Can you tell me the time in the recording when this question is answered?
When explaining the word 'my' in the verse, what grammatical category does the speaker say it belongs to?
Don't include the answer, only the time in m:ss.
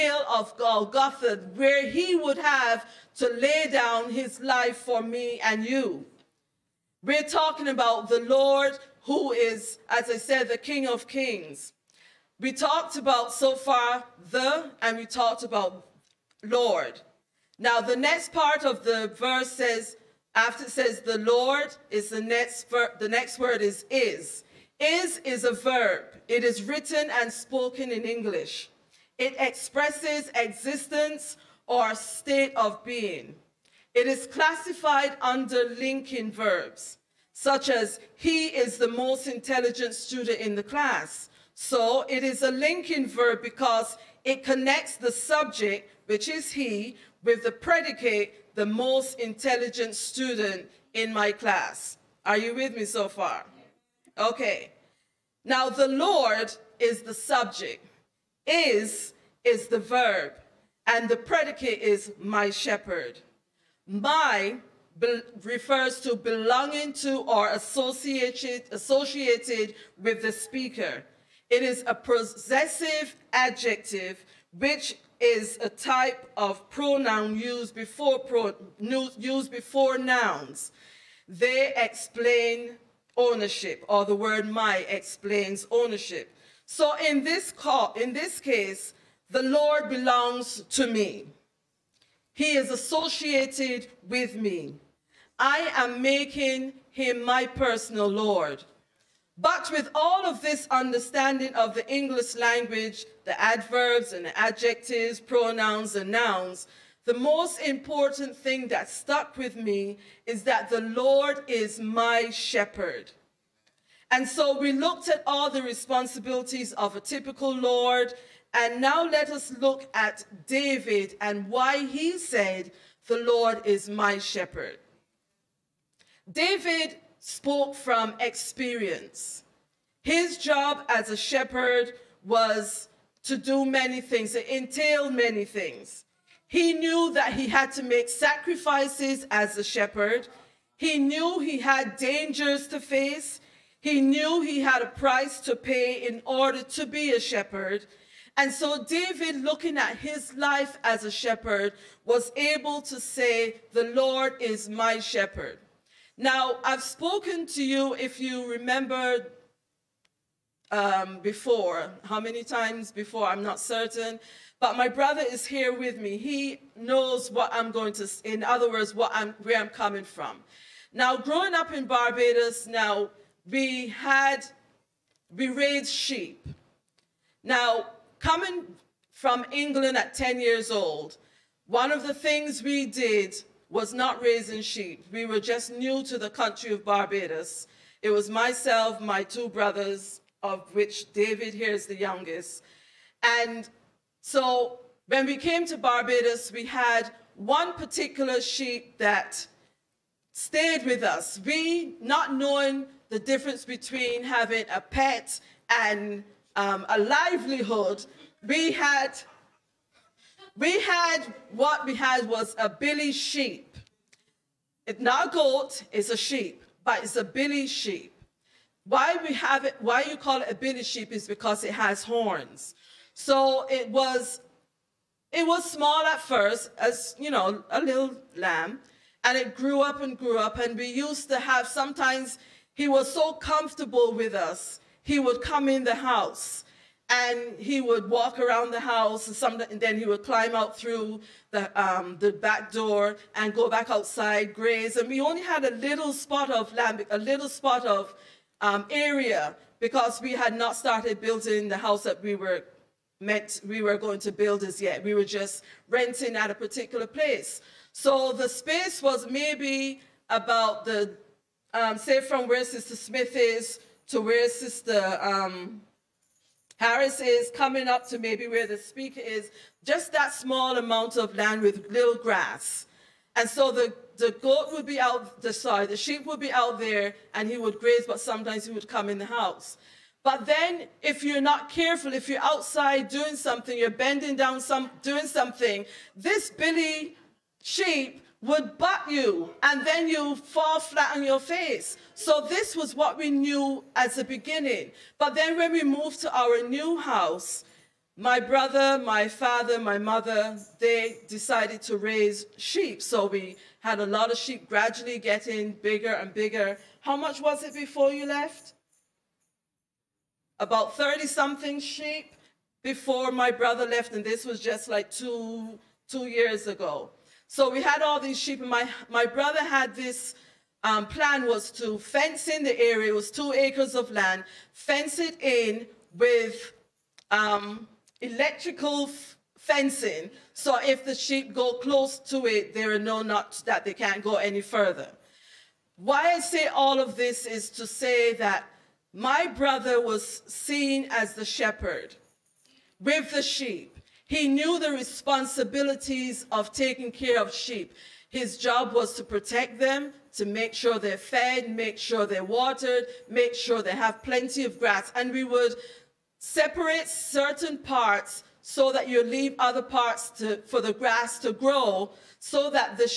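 1:11.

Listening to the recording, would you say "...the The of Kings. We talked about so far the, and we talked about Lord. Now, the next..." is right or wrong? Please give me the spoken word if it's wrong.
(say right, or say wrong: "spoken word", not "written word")
wrong: "King", not "The".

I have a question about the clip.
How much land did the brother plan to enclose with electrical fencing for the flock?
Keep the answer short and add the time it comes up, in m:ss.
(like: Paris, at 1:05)
2 acres, at 5:23.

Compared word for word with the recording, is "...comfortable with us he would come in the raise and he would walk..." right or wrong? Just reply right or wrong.
wrong.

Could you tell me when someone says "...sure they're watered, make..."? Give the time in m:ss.
5:51.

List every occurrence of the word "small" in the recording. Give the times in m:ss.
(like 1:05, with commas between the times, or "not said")
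3:45, 4:30.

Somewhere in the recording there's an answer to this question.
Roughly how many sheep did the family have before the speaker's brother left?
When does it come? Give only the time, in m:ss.
5:10.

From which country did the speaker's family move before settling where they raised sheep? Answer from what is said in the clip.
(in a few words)
England.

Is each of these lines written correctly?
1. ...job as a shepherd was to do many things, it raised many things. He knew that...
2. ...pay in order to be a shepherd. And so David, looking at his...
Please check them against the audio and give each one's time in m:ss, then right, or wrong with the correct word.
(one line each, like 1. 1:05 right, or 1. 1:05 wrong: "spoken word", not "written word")
1. 2:10 wrong: "entailed", not "raised"
2. 2:25 right.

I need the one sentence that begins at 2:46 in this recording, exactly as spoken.
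He knows what I'm going to, in other words, what I'm, where I'm coming from.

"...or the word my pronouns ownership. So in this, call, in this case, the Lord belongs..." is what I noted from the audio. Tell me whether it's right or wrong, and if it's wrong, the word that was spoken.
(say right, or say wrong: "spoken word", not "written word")
wrong: "explains", not "pronouns".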